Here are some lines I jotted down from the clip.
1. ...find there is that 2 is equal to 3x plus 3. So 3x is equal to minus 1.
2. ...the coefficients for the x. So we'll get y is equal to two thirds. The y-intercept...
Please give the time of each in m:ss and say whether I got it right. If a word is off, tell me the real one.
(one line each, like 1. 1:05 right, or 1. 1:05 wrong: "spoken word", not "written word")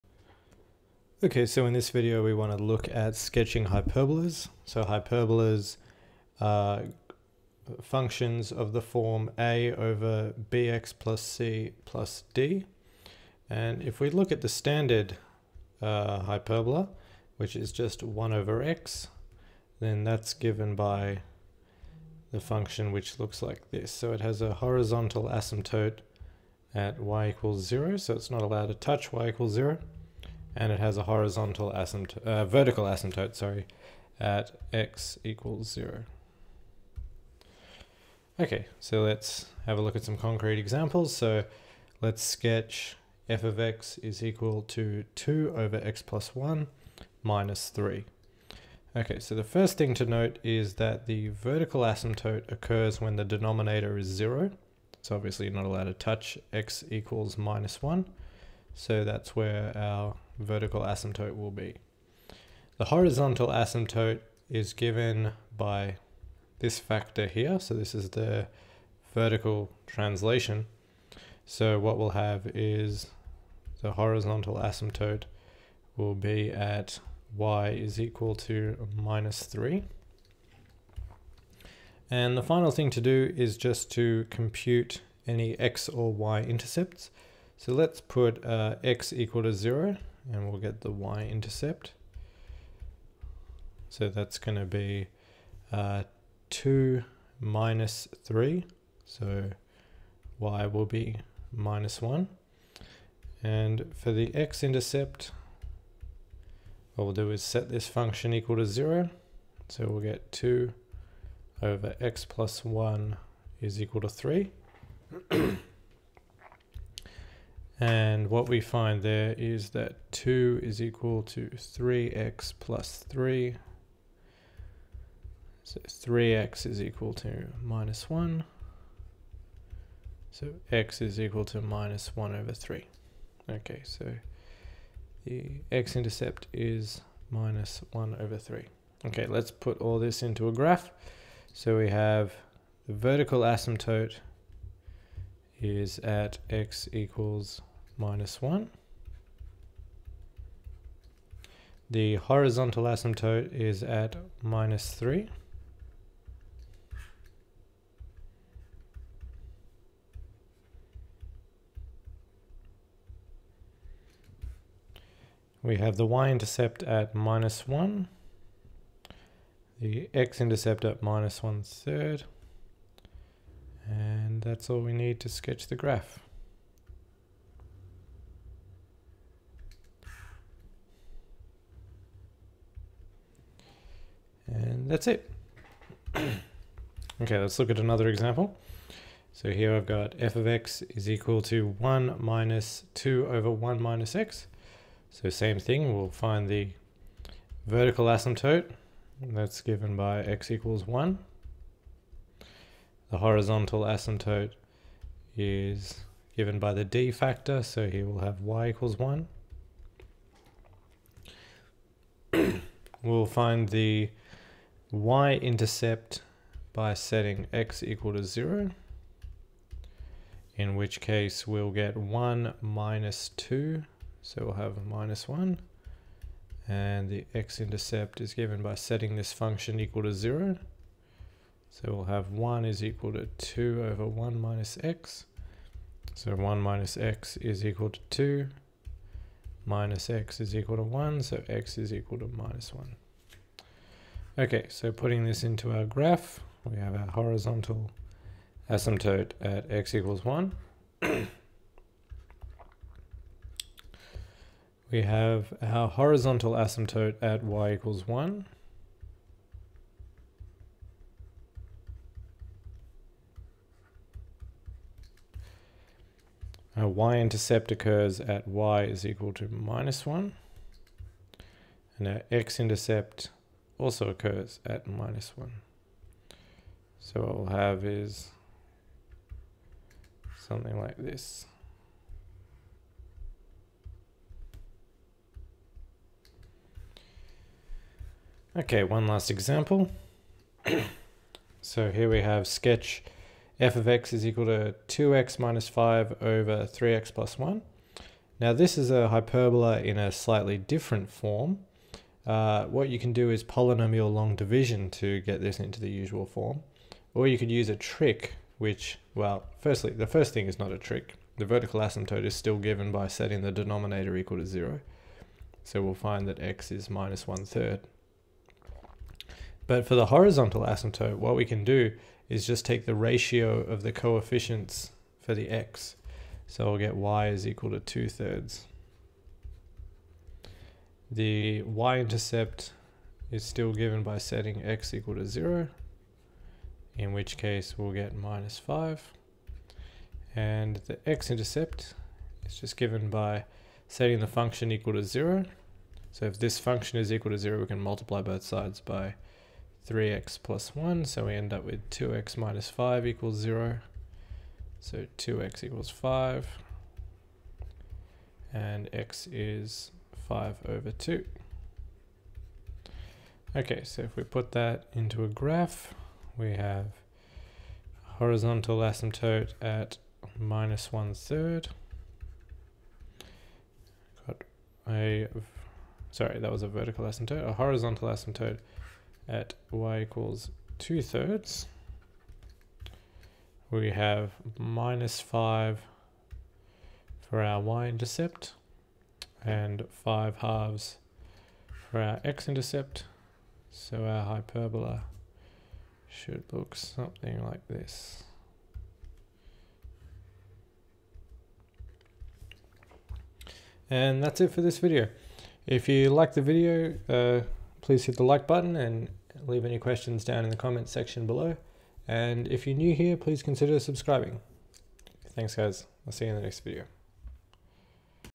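1. 1:58 right
2. 5:23 right.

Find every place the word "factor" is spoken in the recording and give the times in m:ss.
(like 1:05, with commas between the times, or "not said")
1:06, 3:27.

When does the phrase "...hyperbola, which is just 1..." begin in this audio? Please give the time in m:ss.
0:16.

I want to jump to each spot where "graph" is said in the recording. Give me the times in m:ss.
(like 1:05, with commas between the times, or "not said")
2:20, 2:55, 4:05, 6:05.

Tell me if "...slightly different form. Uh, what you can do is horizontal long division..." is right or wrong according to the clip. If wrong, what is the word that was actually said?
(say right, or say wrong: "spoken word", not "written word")
wrong: "polynomial", not "horizontal".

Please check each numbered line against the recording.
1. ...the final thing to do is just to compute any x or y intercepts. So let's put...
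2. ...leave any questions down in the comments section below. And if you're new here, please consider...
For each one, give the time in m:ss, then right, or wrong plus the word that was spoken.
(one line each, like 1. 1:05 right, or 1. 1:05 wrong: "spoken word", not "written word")
1. 1:22 right
2. 6:49 right.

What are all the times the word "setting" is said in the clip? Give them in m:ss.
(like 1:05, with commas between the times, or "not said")
3:36, 3:48, 5:13, 5:34, 5:43.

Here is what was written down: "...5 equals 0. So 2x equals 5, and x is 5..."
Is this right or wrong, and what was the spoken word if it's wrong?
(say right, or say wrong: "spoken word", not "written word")
right.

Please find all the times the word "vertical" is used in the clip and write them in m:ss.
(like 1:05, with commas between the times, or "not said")
0:32, 0:51, 1:00, 1:09, 2:22, 3:17, 5:11, 6:16.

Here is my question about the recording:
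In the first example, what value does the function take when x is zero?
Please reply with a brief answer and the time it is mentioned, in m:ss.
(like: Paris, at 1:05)
-1, at 1:40.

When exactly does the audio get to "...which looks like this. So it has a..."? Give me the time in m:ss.
0:22.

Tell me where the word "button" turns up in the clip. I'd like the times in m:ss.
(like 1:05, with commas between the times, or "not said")
6:48.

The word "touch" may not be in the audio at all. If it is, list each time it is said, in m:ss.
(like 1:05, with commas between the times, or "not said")
0:28, 0:55.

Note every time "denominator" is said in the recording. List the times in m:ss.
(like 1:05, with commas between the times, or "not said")
0:53, 5:13.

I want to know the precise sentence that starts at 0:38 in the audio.
Okay, so let's have a look at some concrete examples.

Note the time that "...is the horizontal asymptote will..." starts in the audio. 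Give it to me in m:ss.
1:12.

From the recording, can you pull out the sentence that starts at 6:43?
And that's it for this video.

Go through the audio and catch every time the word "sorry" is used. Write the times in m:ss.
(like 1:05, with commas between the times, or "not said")
0:33, 6:16.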